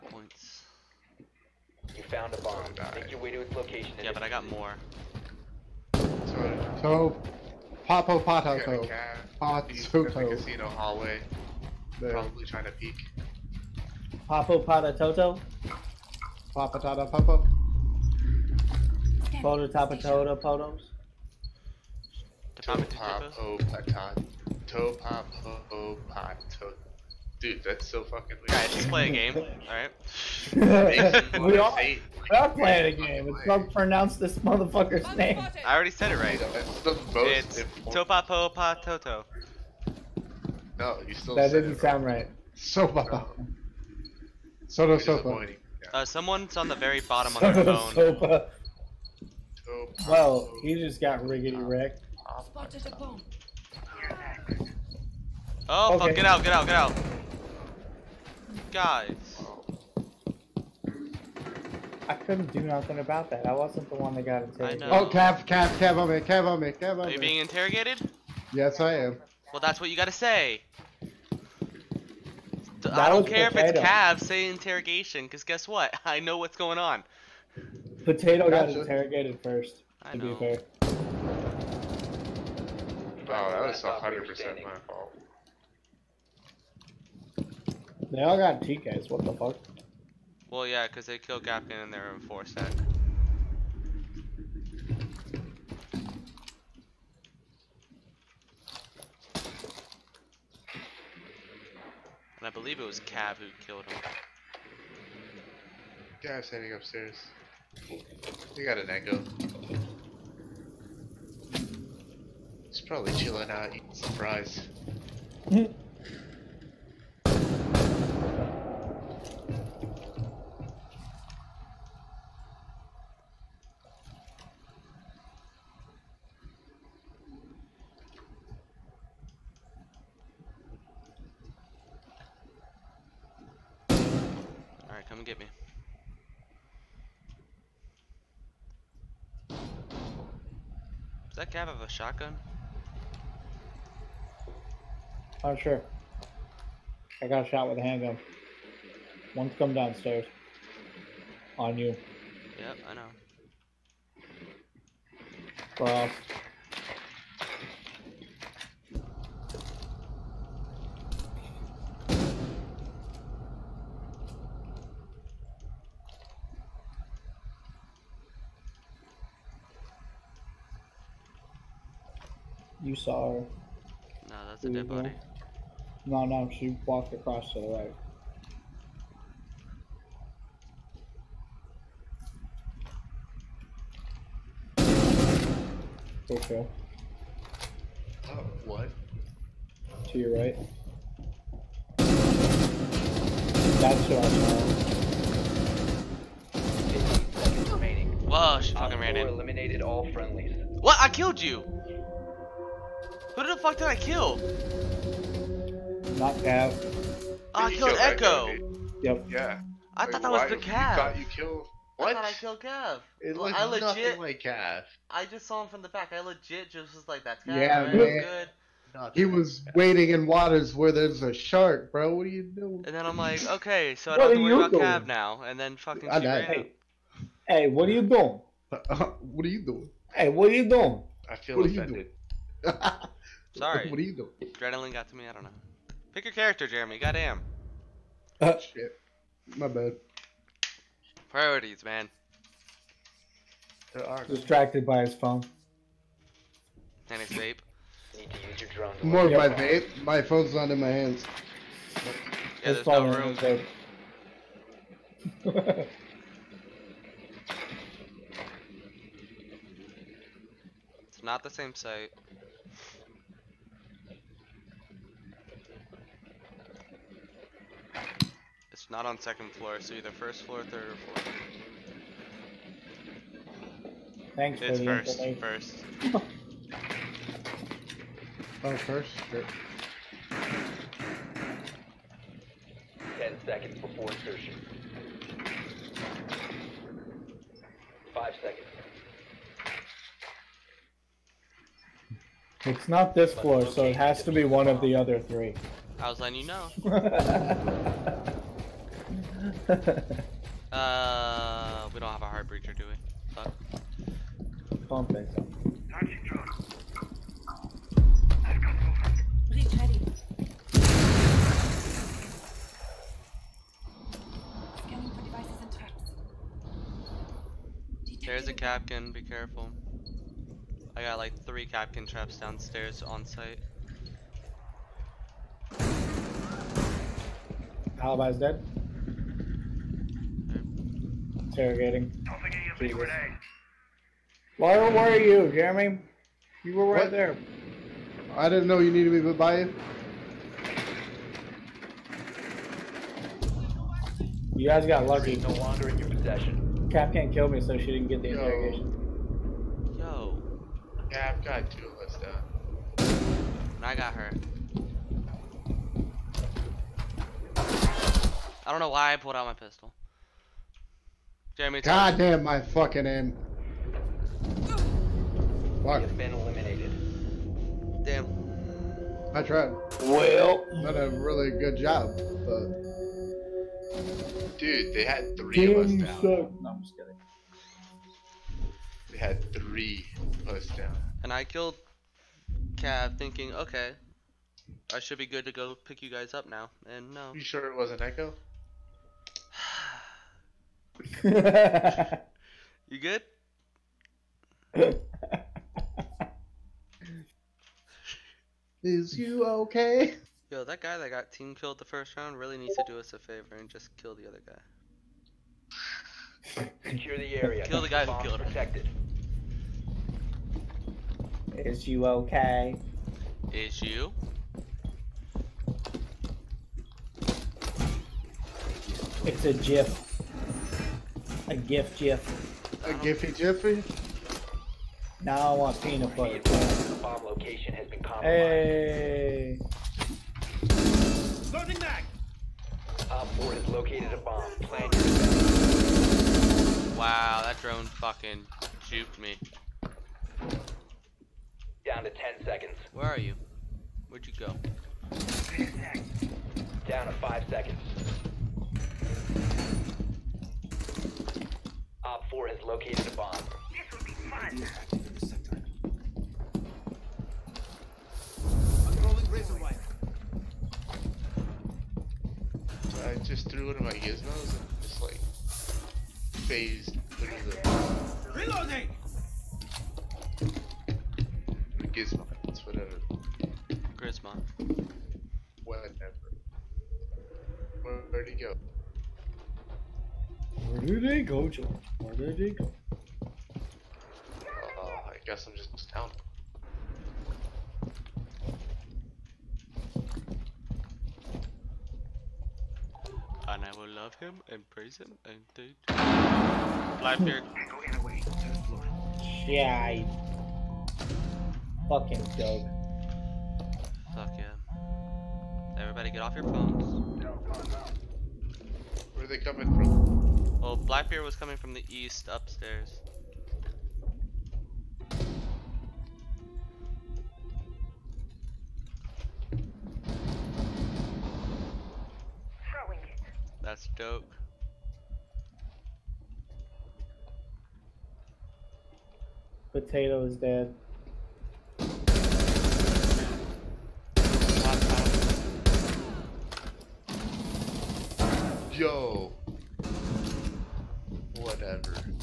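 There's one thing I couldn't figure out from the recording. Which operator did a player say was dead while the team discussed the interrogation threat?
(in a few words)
Alibi.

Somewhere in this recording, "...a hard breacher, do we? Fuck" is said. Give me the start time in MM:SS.
05:02.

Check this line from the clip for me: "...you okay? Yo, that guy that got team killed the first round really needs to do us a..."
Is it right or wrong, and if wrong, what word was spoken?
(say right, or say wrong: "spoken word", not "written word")
right.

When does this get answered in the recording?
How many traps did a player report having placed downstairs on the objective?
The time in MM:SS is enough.
05:21.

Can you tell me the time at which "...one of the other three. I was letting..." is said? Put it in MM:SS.
04:54.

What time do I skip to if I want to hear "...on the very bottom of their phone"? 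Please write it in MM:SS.
00:46.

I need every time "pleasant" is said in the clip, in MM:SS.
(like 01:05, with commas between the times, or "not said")
not said.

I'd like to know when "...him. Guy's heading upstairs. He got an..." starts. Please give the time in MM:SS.
01:43.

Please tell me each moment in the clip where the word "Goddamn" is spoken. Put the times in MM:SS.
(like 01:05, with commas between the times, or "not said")
03:56.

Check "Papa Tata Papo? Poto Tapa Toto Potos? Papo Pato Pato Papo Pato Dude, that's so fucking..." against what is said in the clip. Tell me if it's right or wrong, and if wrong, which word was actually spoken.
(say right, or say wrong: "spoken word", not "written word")
right.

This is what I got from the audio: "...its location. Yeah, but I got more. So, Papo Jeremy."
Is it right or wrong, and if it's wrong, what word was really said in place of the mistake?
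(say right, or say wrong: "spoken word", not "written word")
wrong: "Patato", not "Jeremy".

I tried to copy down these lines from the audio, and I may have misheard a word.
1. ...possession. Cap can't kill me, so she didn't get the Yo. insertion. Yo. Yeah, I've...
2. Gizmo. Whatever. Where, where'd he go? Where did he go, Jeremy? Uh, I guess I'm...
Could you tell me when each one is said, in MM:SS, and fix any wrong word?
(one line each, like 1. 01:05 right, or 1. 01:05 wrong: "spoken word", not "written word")
1. 05:46 wrong: "interrogation", not "insertion"
2. 07:53 wrong: "George", not "Jeremy".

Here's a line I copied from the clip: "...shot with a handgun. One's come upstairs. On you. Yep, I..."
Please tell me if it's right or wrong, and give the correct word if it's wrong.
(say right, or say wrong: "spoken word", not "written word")
wrong: "downstairs", not "upstairs".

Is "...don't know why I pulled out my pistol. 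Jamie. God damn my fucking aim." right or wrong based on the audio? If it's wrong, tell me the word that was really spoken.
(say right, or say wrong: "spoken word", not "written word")
right.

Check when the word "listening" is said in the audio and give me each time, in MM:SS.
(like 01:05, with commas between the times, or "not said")
not said.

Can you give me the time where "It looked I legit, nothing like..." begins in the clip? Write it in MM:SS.
03:33.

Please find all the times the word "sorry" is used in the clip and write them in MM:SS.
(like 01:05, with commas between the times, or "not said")
02:53, 03:53.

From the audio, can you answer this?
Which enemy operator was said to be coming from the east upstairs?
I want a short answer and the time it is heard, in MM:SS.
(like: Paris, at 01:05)
Blackbeard, at 08:30.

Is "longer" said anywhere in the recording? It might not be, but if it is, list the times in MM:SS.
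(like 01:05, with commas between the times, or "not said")
05:45.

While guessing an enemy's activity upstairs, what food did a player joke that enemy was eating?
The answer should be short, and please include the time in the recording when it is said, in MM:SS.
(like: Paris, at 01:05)
Fries, at 01:54.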